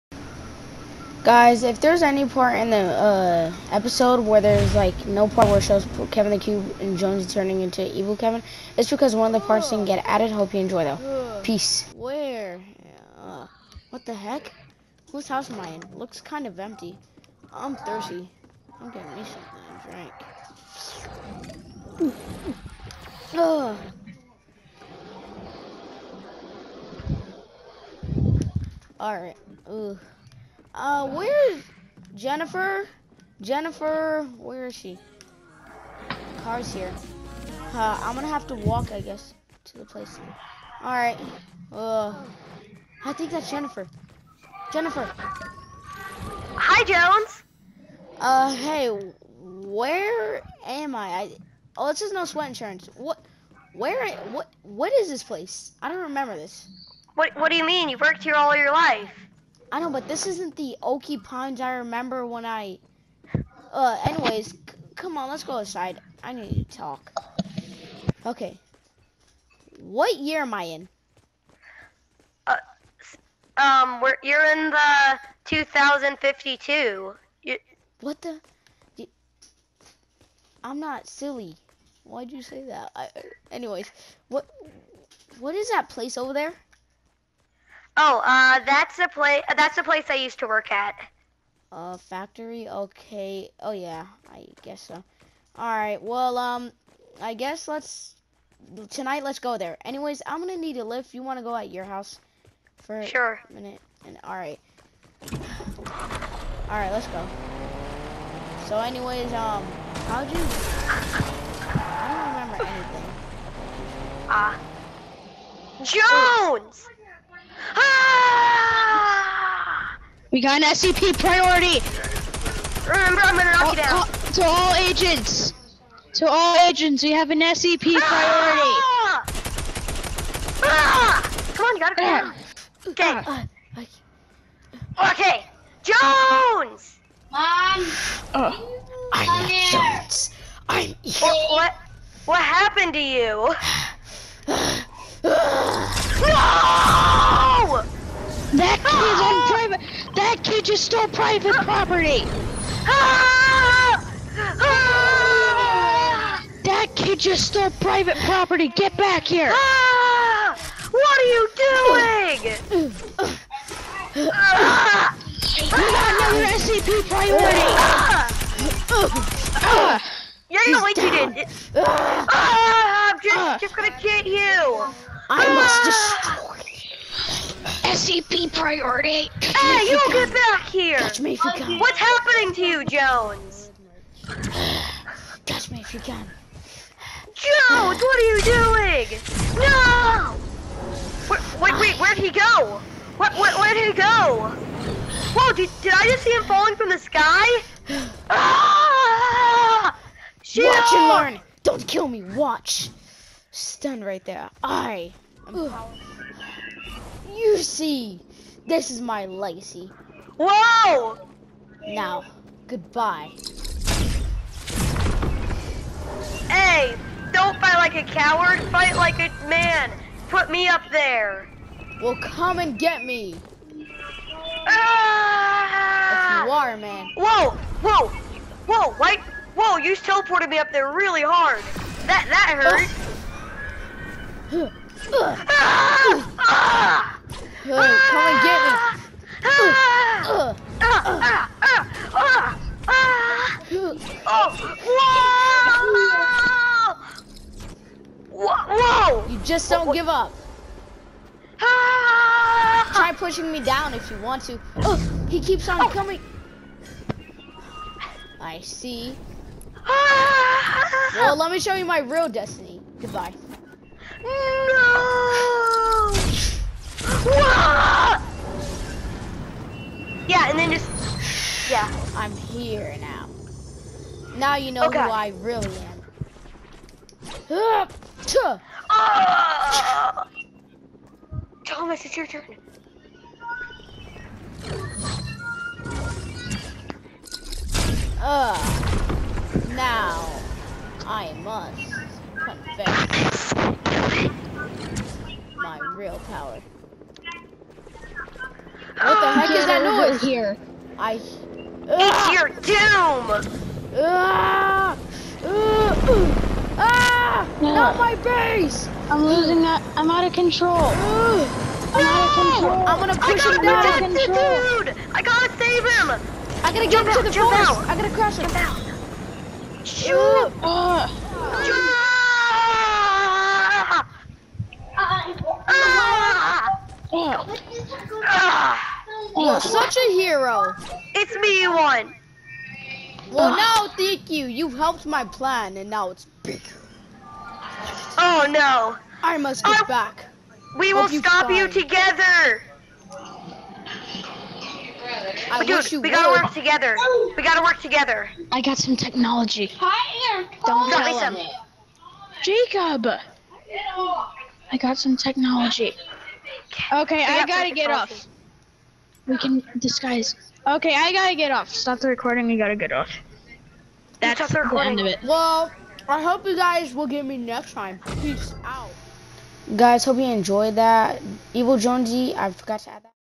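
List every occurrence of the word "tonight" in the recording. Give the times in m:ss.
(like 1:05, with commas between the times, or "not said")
1:38.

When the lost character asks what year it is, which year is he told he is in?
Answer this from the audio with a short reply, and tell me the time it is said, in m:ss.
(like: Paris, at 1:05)
2052, at 1:15.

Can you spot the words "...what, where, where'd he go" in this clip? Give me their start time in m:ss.
3:13.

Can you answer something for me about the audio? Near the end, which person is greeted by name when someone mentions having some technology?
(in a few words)
Jacob.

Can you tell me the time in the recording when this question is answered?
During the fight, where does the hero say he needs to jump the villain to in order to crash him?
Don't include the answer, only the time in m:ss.
5:17.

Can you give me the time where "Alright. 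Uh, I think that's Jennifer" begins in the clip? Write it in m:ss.
0:40.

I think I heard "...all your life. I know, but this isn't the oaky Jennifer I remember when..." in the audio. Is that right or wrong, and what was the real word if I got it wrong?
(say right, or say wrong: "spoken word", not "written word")
wrong: "Pines", not "Jennifer".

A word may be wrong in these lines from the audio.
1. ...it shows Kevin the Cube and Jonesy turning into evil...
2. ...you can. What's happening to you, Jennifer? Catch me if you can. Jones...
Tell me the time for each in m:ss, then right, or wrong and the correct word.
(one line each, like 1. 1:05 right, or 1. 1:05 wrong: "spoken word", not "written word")
1. 0:05 right
2. 3:01 wrong: "Jones", not "Jennifer".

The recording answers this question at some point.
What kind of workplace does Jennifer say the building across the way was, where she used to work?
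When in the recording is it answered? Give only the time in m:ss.
1:31.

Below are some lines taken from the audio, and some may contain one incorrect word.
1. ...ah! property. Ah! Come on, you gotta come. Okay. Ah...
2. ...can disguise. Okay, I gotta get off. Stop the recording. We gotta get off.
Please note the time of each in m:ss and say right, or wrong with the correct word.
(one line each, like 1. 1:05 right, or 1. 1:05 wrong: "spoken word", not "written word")
1. 2:08 wrong: "priority", not "property"
2. 5:59 right.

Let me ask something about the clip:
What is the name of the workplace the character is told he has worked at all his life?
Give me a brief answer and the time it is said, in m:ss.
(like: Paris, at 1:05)
No Sweat Insurance, at 0:52.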